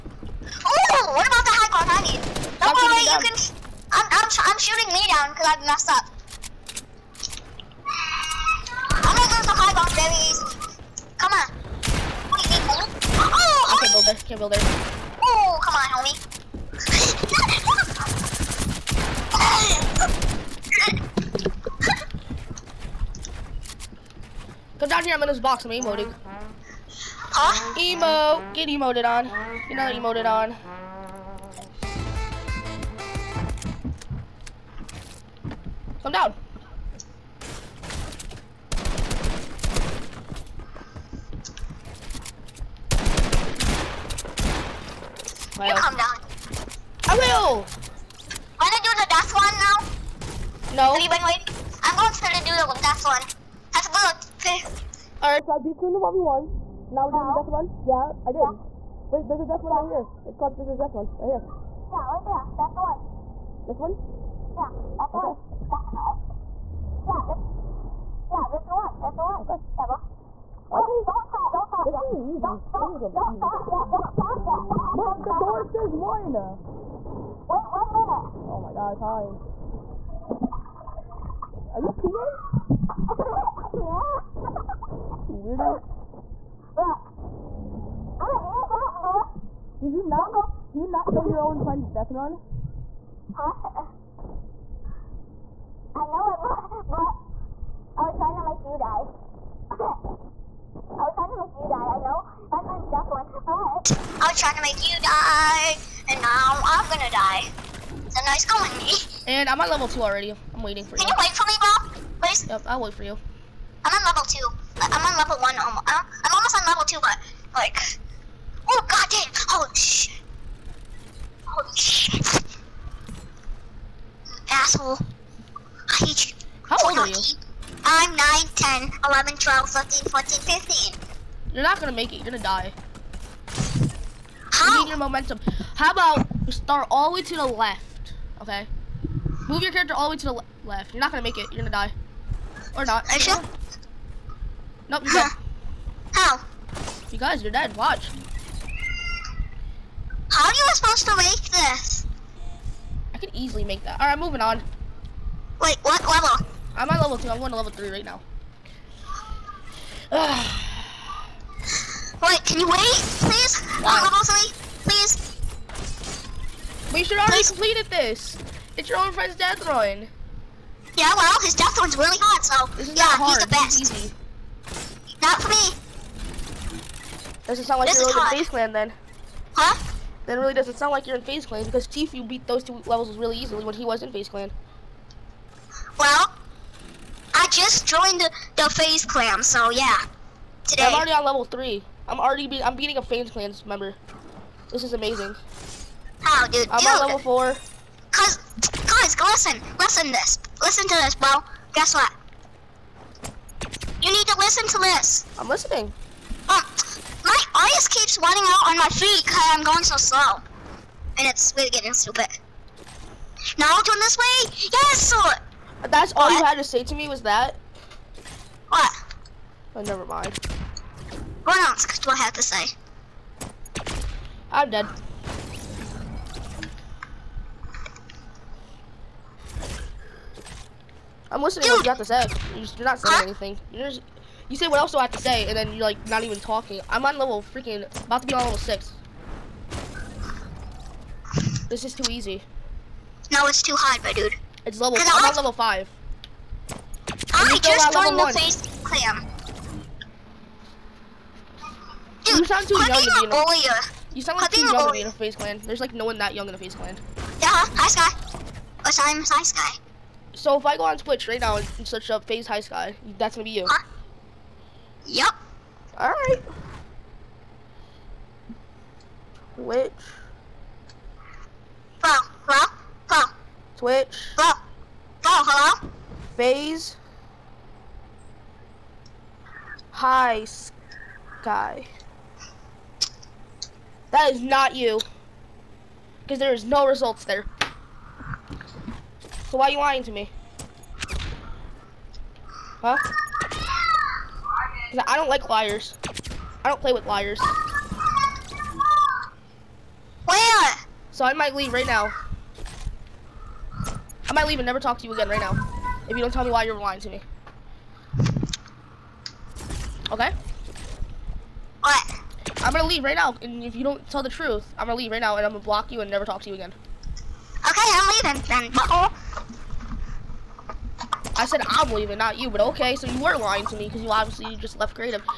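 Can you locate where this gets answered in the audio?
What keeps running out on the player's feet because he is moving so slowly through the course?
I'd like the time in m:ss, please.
3:27.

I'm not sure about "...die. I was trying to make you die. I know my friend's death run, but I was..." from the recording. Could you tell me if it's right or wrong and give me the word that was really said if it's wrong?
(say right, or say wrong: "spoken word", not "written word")
right.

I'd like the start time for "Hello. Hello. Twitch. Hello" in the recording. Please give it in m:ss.
4:32.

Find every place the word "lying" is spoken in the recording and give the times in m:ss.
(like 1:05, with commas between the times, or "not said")
4:49, 5:06, 5:23.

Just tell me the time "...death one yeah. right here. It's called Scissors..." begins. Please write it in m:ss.
0:59.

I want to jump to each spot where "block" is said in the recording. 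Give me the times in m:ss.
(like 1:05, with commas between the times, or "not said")
5:15.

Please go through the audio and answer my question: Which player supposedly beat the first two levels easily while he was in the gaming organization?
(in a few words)
Tfue.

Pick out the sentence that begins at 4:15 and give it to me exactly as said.
There's like no one that young in the FaZe Clan.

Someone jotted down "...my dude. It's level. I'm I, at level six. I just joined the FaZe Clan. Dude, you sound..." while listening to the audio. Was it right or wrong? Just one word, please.
wrong.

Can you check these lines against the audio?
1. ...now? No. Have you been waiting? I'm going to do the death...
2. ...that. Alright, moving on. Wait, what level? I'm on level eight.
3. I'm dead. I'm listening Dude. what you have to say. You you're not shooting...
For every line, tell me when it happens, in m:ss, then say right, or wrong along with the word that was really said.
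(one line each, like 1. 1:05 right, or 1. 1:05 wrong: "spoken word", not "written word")
1. 0:49 right
2. 2:33 wrong: "two", not "eight"
3. 3:44 wrong: "saying", not "shooting".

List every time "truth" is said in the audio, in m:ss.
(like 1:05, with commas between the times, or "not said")
5:14.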